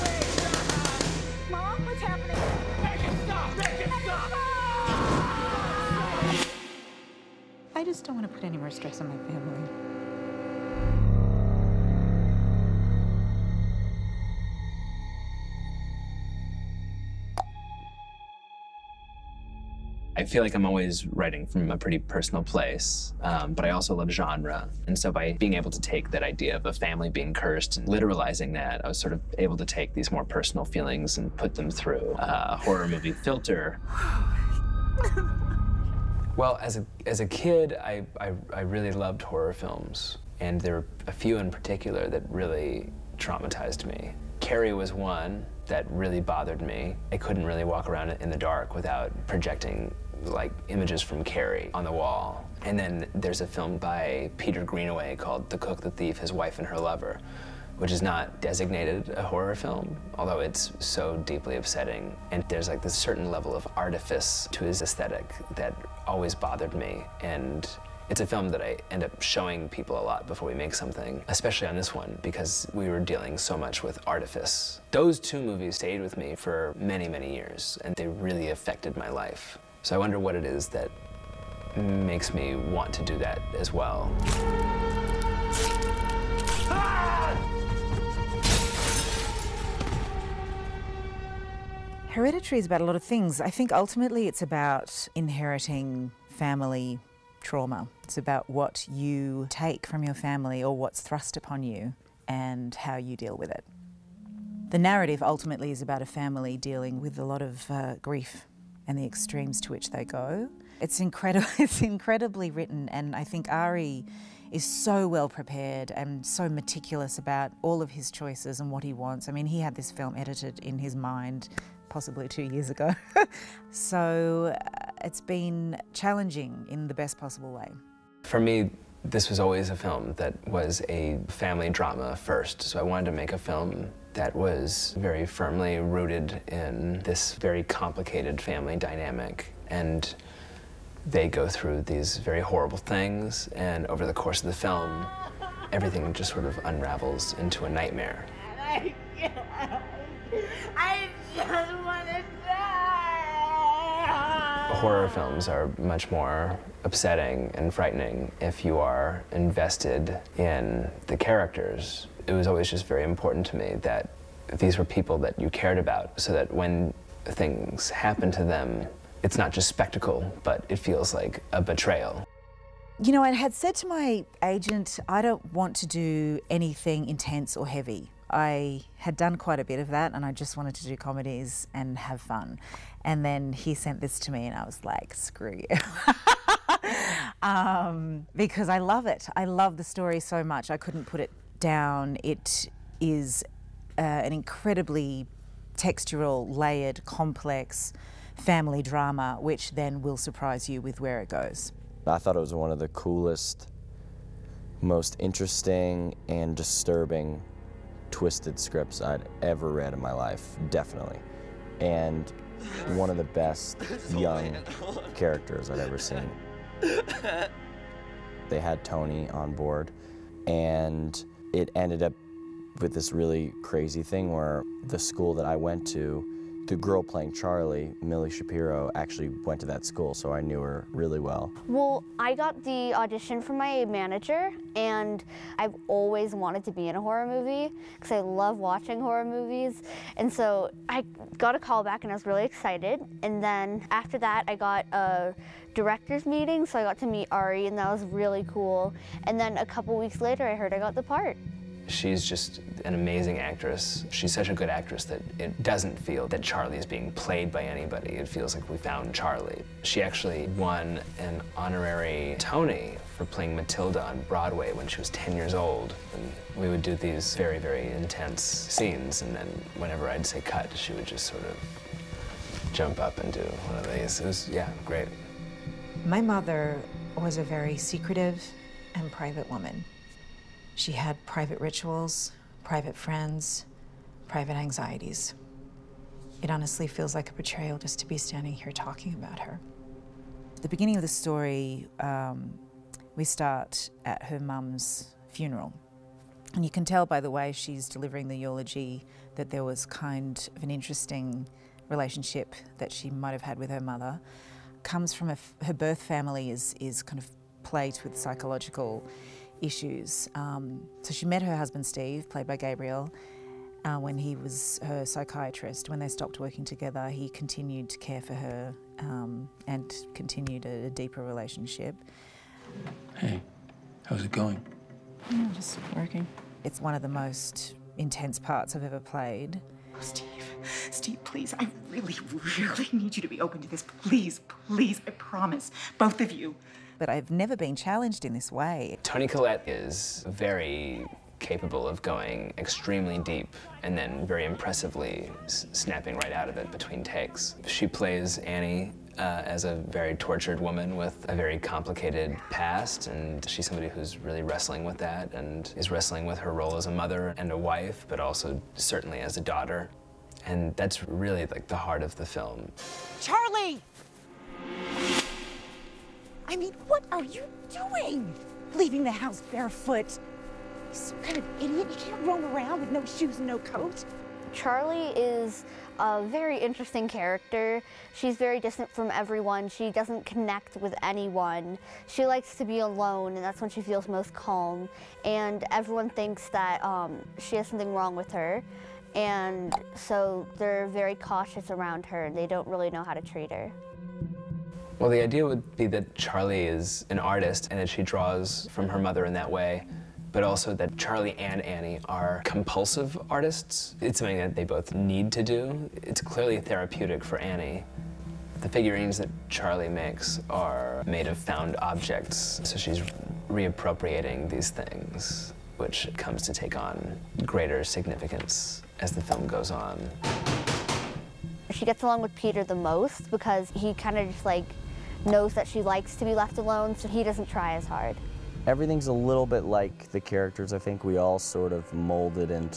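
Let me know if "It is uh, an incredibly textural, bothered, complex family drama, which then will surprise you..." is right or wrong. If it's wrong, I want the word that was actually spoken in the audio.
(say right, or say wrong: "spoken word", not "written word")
wrong: "layered", not "bothered".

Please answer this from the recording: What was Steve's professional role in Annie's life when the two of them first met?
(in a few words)
psychiatrist.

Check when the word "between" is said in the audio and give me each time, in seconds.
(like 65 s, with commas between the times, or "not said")
346 s.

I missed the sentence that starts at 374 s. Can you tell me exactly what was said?
Charlie is a very interesting character.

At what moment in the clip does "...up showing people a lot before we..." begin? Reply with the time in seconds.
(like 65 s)
69 s.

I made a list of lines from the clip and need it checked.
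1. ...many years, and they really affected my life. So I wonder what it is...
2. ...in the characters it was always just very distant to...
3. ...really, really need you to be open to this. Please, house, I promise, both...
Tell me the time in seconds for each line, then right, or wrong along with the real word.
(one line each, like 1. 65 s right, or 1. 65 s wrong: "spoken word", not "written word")
1. 77 s right
2. 160 s wrong: "important", not "distant"
3. 331 s wrong: "please", not "house".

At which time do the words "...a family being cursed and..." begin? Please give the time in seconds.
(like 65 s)
26 s.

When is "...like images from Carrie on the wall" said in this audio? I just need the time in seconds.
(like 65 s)
50 s.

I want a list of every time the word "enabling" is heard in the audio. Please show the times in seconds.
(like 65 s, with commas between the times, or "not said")
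not said.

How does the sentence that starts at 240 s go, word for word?
And so I got a call back, and I was really excited.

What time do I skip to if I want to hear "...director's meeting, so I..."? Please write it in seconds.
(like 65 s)
245 s.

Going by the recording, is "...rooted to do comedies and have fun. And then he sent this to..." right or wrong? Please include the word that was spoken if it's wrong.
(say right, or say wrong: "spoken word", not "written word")
wrong: "wanted", not "rooted".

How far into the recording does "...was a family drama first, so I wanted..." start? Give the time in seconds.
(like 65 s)
130 s.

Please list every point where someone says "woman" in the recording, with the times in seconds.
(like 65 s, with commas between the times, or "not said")
279 s, 350 s.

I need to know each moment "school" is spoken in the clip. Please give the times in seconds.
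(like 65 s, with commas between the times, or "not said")
224 s, 229 s.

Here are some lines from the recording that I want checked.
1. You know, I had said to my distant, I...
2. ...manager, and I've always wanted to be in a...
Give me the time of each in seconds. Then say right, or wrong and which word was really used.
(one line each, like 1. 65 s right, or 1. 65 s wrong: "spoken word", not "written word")
1. 173 s wrong: "agent", not "distant"
2. 233 s right.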